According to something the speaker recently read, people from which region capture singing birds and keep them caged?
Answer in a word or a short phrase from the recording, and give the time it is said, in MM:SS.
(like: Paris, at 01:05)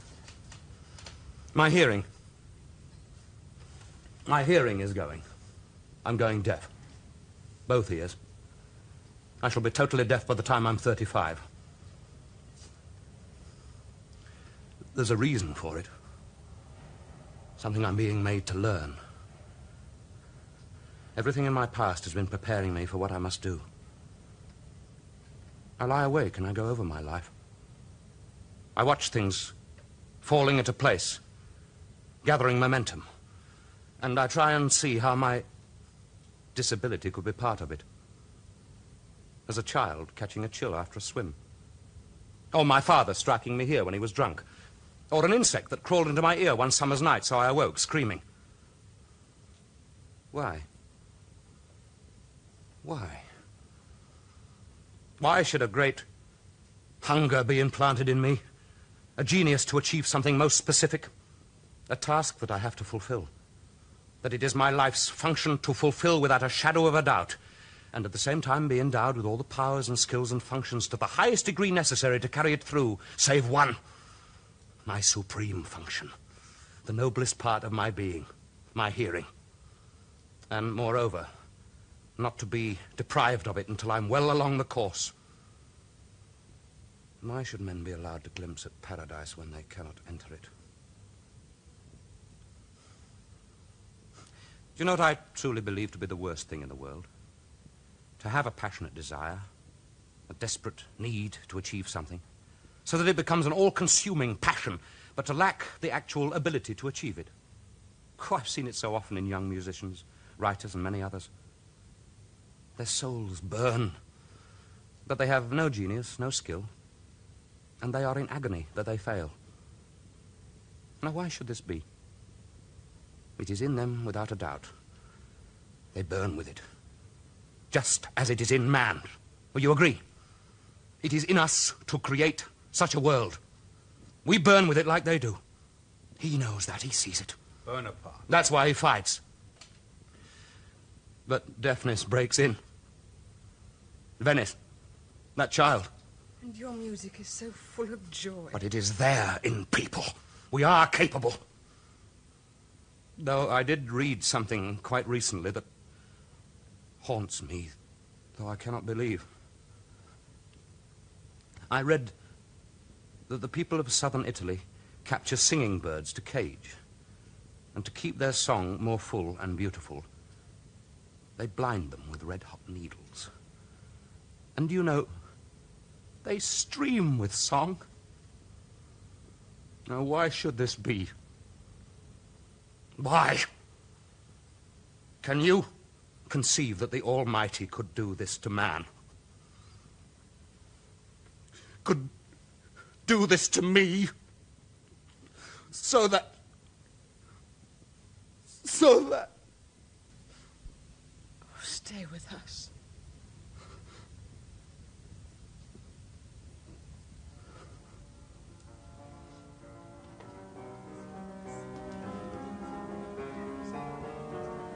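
Southern Italy, at 02:43.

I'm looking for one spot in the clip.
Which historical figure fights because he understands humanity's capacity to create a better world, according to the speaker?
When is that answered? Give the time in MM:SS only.
02:17.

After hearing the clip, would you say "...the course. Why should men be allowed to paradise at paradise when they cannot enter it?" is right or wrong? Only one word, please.
wrong.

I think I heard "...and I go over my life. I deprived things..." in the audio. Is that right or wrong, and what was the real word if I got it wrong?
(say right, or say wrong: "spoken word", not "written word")
wrong: "watched", not "deprived".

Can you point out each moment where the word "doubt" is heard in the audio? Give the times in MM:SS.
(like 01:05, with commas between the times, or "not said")
01:07, 02:04.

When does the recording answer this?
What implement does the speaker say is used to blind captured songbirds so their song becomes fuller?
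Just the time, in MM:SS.
02:52.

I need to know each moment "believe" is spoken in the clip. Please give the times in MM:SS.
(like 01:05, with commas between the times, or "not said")
01:35, 02:38.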